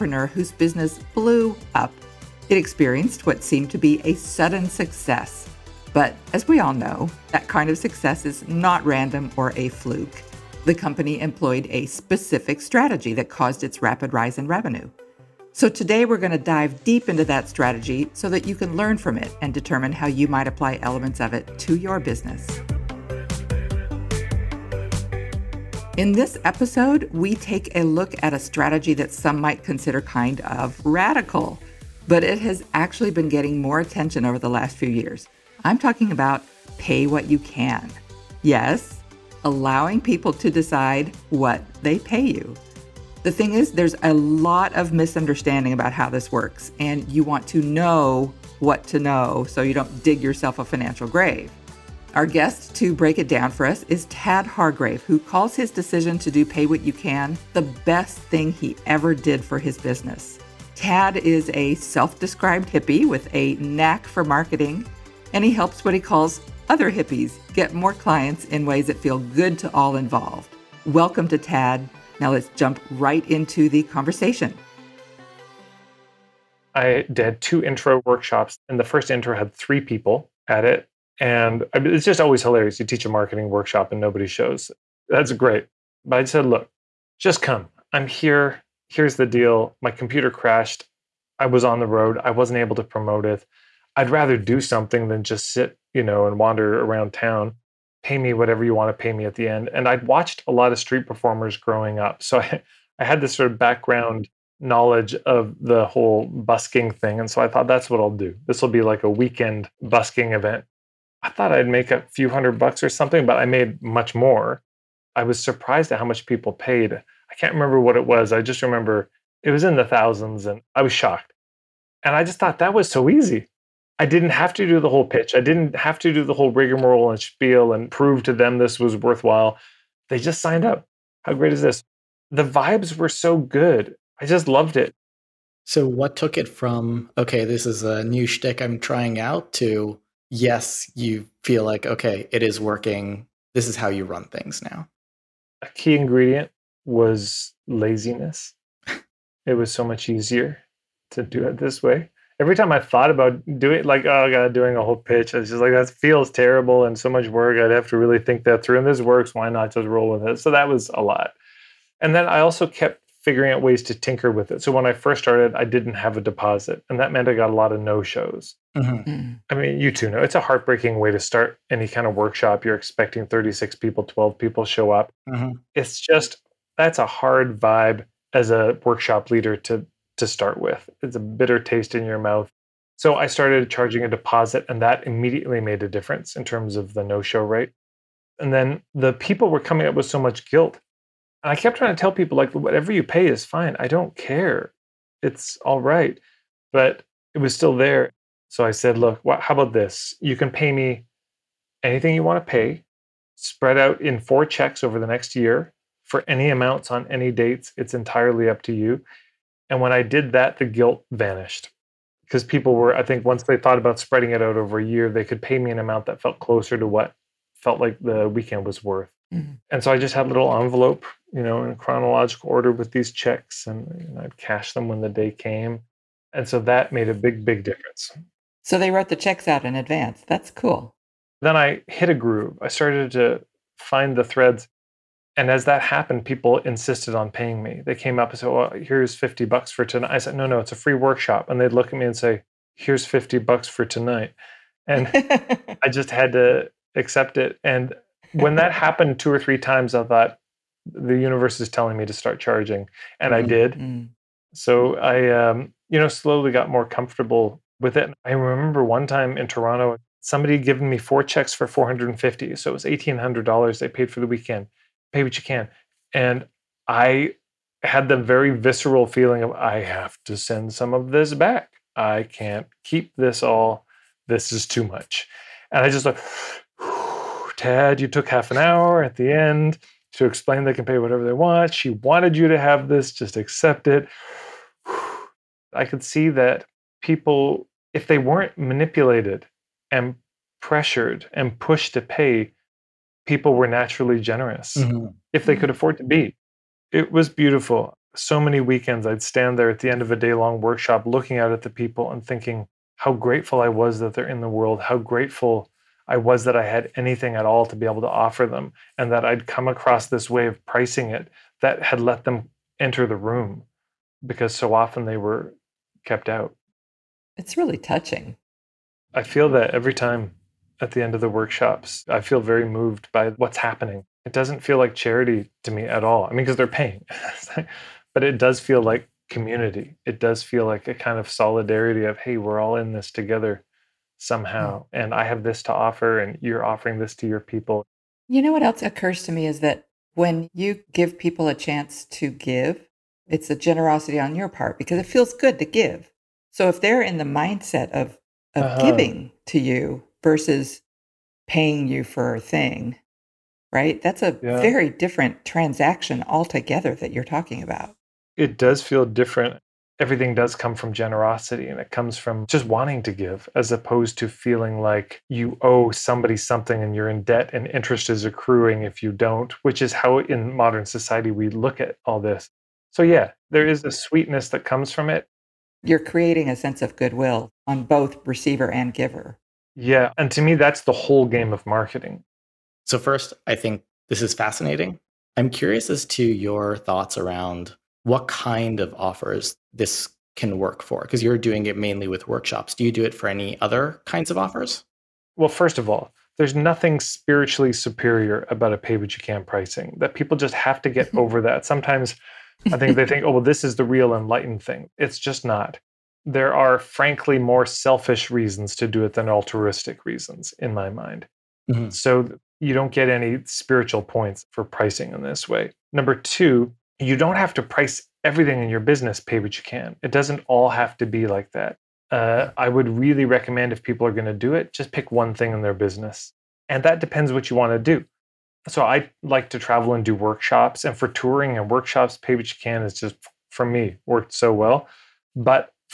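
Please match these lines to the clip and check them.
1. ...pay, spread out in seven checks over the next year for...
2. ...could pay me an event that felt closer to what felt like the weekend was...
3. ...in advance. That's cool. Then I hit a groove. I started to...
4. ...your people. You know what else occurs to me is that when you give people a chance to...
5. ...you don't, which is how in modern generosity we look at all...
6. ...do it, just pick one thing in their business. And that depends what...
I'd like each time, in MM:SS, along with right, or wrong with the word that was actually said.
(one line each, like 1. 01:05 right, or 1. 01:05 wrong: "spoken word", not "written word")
1. 03:22 wrong: "four", not "seven"
2. 03:35 wrong: "amount", not "event"
3. 03:49 right
4. 05:37 right
5. 06:09 wrong: "society", not "generosity"
6. 07:04 right.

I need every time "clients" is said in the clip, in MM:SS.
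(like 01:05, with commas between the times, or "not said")
01:07.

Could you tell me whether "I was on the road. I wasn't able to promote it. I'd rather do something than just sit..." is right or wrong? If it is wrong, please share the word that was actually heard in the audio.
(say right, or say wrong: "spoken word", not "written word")
right.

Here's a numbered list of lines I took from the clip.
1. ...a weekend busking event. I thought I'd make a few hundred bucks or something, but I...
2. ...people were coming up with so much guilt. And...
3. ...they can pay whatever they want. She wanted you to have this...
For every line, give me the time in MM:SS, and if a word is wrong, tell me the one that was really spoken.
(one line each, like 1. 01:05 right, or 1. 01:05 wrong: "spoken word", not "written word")
1. 01:49 right
2. 03:09 right
3. 04:40 right.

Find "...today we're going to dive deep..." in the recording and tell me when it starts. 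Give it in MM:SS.
00:15.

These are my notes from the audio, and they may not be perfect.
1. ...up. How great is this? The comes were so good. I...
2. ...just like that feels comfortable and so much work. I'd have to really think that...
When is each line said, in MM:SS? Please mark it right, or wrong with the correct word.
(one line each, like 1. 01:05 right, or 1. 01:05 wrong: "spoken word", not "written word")
1. 02:10 wrong: "vibes", not "comes"
2. 02:35 wrong: "terrible", not "comfortable".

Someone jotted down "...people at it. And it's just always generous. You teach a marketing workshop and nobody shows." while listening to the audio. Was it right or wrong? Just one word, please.
wrong.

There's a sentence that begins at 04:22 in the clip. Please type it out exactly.
So it was $1,800 they paid for the weekend pay what you can.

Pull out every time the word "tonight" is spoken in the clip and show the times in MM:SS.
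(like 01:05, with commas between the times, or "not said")
03:59, 04:03.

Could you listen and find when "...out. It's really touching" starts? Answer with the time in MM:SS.
05:16.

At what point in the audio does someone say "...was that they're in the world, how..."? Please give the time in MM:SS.
05:03.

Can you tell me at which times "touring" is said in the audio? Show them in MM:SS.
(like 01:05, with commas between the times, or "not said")
07:11.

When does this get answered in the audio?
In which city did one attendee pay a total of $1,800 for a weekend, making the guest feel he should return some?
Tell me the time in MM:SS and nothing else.
04:19.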